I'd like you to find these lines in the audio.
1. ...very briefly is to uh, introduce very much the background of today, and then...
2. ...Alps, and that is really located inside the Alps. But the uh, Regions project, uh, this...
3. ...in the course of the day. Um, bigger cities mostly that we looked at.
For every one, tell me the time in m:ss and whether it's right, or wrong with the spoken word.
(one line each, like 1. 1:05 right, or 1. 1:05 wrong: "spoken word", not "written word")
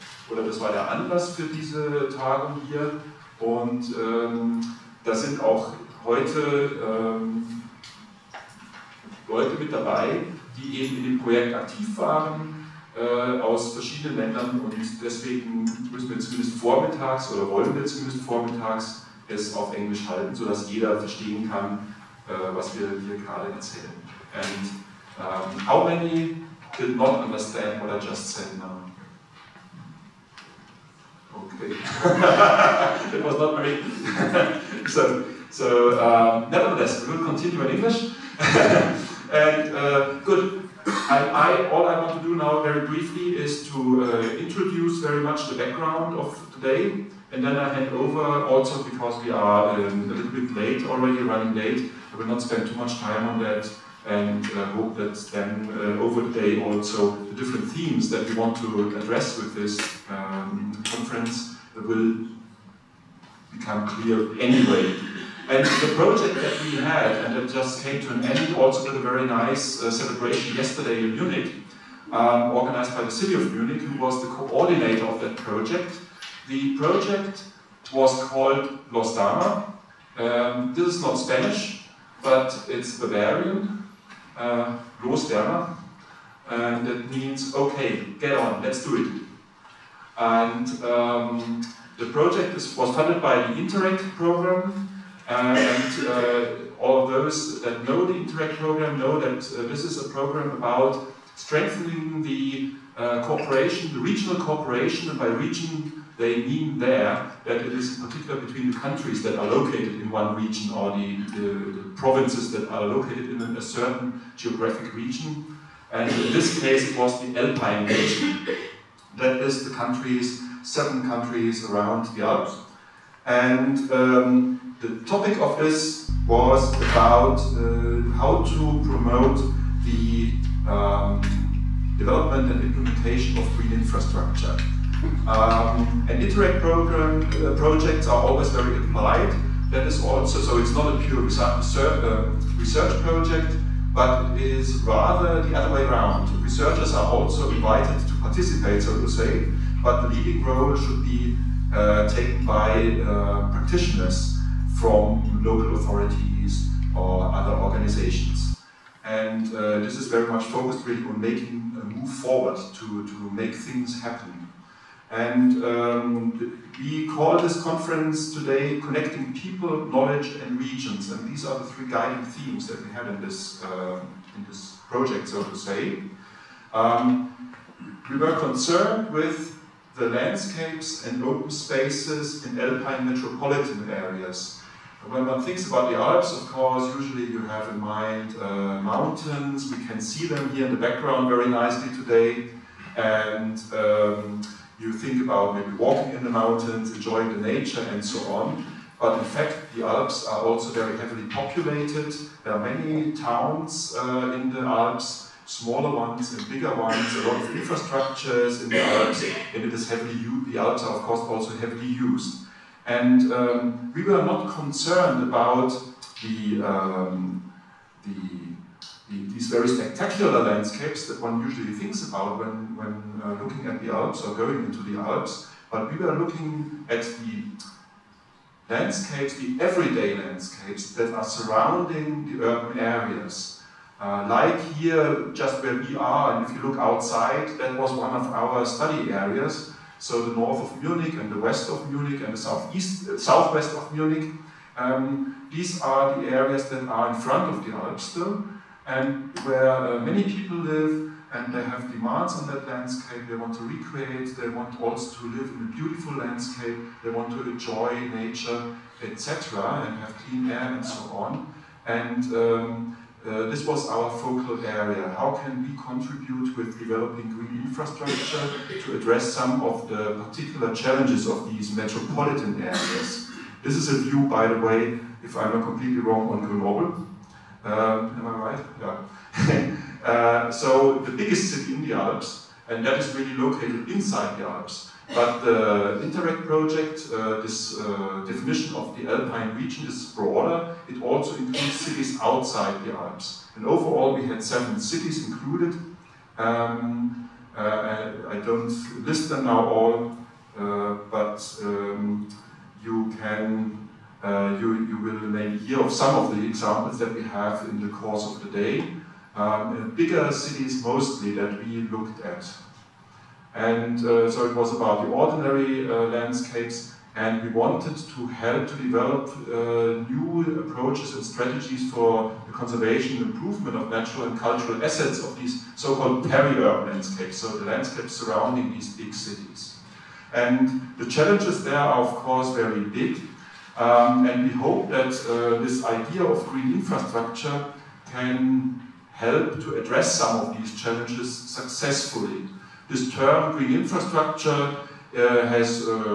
1. 0:42 right
2. 4:41 wrong: "Interreg", not "Regions"
3. 5:07 right.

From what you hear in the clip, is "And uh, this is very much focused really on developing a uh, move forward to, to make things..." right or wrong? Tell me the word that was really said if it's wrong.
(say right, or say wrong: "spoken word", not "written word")
wrong: "making", not "developing".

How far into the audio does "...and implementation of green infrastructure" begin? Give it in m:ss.
2:12.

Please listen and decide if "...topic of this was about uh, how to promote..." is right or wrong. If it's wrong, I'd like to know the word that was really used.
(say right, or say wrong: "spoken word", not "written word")
right.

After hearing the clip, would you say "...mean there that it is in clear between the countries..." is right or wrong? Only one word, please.
wrong.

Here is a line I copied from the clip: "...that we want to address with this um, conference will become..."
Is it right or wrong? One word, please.
right.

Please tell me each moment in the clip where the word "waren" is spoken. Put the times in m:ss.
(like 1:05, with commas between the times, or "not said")
0:11.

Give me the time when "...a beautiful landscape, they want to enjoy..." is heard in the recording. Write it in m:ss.
4:15.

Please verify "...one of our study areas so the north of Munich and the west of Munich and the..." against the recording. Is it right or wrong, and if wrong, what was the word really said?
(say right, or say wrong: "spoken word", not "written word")
right.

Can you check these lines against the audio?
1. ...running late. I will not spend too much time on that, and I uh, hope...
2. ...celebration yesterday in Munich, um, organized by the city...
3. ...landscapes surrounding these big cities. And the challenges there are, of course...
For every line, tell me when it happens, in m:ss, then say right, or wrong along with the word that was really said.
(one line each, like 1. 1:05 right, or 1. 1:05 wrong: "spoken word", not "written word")
1. 0:51 right
2. 1:09 right
3. 5:27 right.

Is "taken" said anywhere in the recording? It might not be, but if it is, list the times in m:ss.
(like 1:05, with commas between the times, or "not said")
2:32.